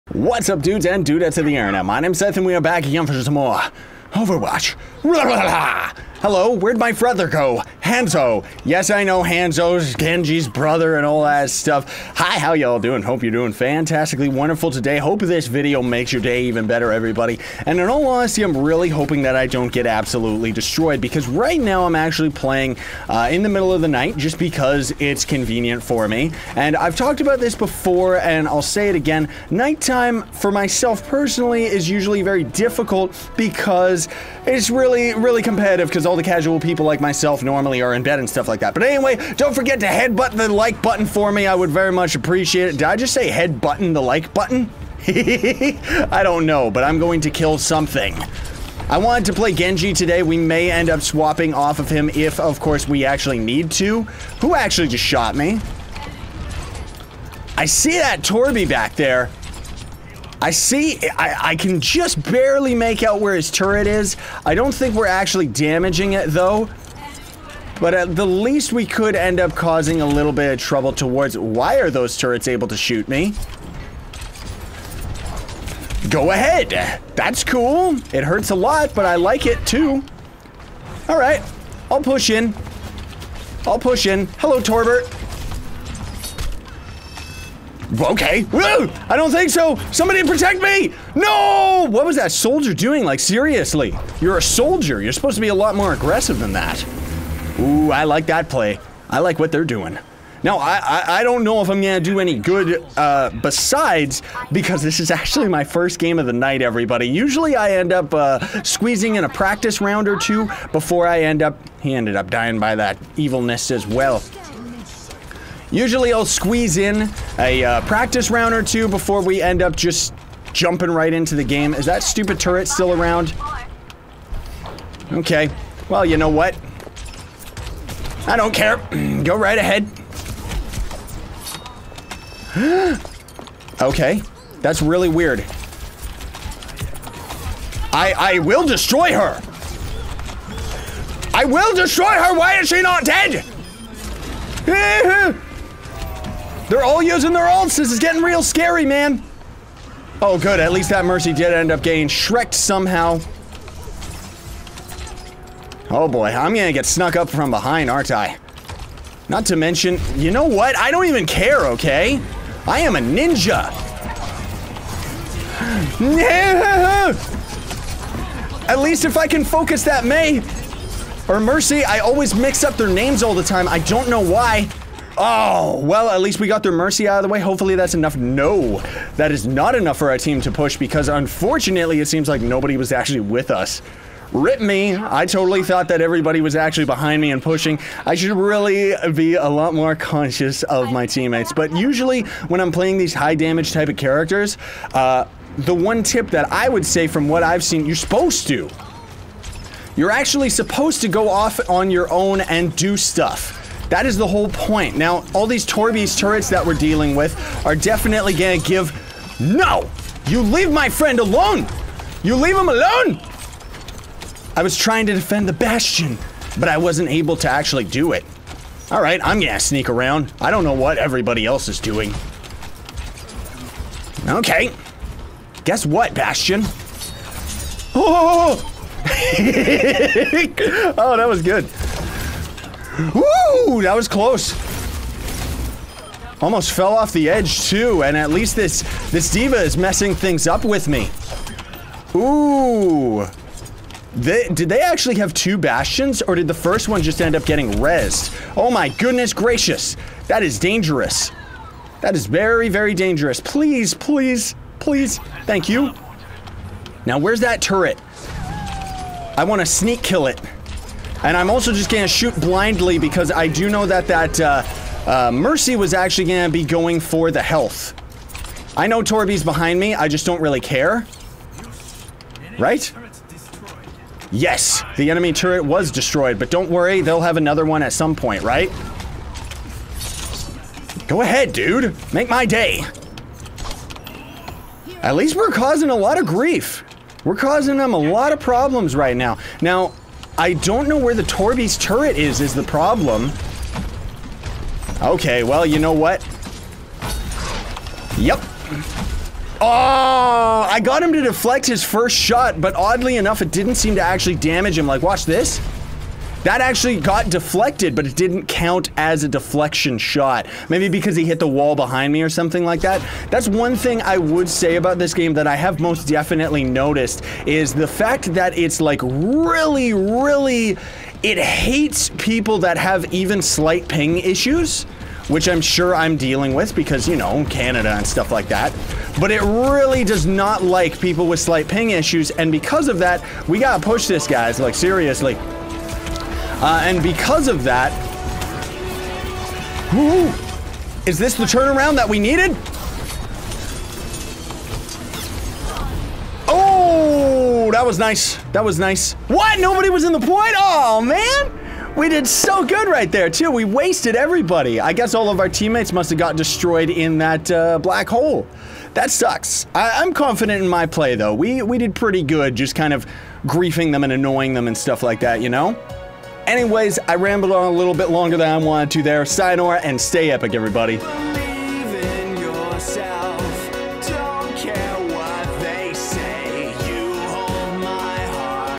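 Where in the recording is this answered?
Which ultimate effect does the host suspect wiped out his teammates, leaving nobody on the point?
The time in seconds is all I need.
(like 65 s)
357 s.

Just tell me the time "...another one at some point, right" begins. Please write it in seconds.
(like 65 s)
277 s.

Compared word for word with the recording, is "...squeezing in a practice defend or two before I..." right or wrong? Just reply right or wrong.
wrong.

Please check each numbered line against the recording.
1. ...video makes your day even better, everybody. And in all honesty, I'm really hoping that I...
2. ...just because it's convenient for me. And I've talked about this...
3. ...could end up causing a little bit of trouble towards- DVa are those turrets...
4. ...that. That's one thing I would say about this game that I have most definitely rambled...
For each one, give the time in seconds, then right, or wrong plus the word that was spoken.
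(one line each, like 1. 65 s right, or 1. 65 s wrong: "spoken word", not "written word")
1. 15 s right
2. 24 s right
3. 68 s wrong: "Why", not "DVa"
4. 312 s wrong: "noticed", not "rambled".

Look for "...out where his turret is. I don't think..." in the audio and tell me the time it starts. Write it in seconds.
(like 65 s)
63 s.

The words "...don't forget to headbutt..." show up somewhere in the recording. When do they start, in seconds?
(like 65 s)
39 s.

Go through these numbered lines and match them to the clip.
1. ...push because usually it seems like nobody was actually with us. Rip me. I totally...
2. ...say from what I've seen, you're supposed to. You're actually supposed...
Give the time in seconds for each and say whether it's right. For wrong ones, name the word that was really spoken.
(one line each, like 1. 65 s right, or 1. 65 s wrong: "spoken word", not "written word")
1. 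180 s wrong: "unfortunately", not "usually"
2. 196 s right.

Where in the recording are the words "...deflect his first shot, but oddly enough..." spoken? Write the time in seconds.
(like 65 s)
301 s.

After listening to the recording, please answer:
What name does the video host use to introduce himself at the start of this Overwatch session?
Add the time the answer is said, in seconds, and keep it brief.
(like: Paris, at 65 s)
Scythe, at 2 s.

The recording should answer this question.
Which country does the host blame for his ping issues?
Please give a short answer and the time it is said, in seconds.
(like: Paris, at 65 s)
Canada, at 327 s.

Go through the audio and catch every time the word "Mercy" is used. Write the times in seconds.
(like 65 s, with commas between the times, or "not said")
151 s, 171 s, 176 s, 265 s.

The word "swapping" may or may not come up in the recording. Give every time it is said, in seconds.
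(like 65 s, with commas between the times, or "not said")
50 s.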